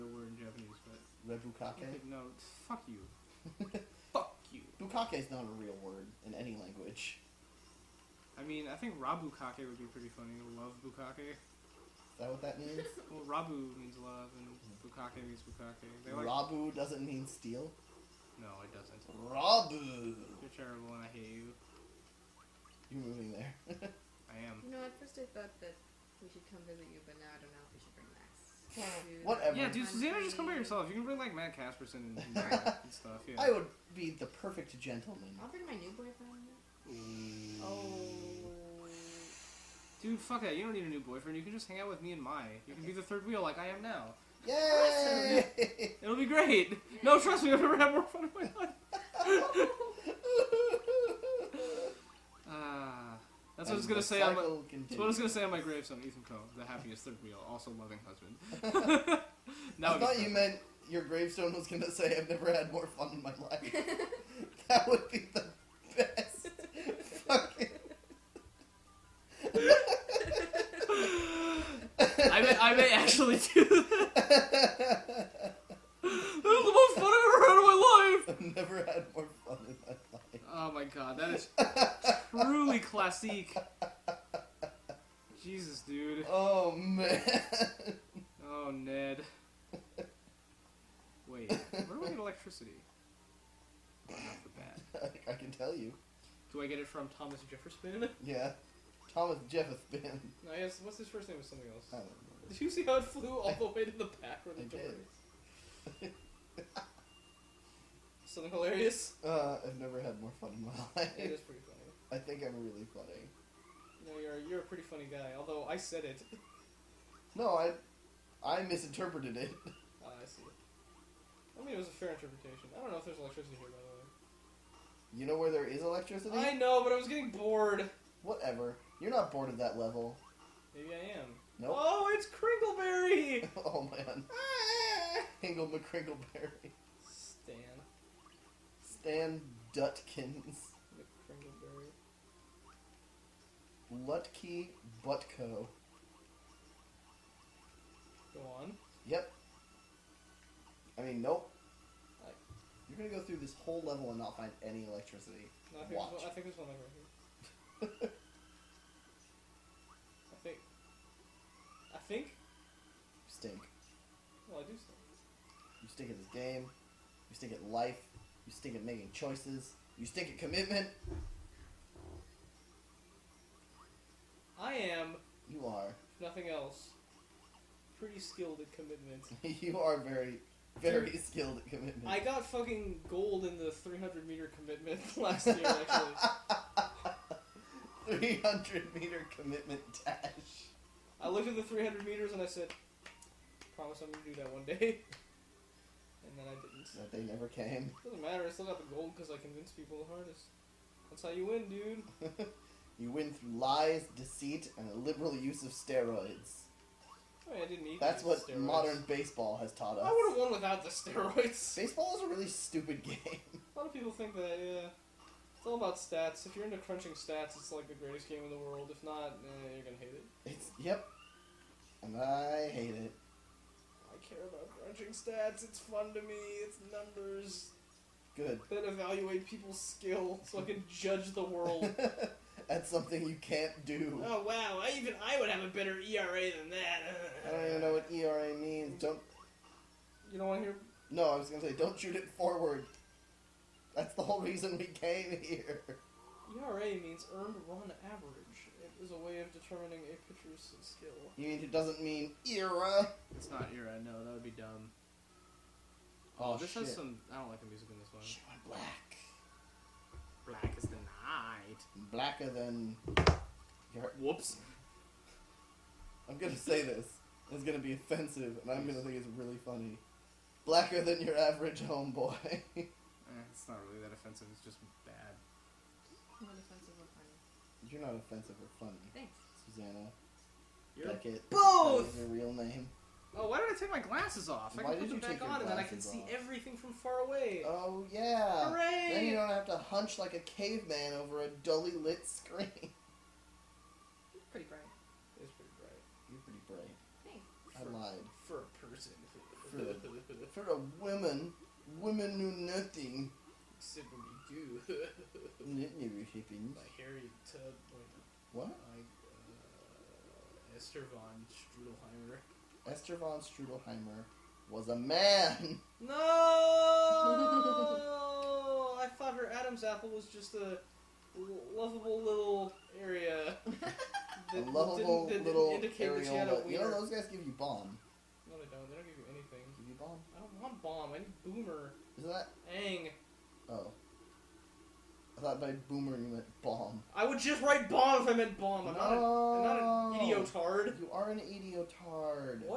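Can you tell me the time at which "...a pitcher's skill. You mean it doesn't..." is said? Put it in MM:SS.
04:10.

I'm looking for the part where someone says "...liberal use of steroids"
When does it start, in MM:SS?
03:24.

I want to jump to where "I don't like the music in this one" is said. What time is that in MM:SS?
04:17.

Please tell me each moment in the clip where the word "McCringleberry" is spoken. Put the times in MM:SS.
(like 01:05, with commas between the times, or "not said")
02:15, 02:20.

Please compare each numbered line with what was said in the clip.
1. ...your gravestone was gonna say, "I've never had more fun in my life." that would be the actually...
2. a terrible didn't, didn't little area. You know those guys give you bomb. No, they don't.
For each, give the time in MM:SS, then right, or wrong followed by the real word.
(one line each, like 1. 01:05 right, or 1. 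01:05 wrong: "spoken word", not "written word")
1. 01:00 right
2. 05:23 wrong: "lovable", not "terrible".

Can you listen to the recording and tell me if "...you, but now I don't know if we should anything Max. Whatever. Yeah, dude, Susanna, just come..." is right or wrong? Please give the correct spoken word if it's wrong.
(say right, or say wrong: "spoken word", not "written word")
wrong: "bring", not "anything".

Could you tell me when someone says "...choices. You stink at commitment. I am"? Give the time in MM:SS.
02:49.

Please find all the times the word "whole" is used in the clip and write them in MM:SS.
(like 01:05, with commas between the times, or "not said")
02:33, 04:04.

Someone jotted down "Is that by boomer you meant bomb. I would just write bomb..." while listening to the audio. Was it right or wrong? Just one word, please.
right.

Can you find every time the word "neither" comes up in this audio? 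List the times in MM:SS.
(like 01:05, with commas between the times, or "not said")
not said.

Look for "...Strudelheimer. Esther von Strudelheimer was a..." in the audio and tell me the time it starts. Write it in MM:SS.
05:11.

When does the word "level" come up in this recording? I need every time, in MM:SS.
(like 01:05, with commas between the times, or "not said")
02:09, 02:33.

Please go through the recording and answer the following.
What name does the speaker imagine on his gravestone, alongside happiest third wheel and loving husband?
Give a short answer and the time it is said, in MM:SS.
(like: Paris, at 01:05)
Ethan Coe, at 00:55.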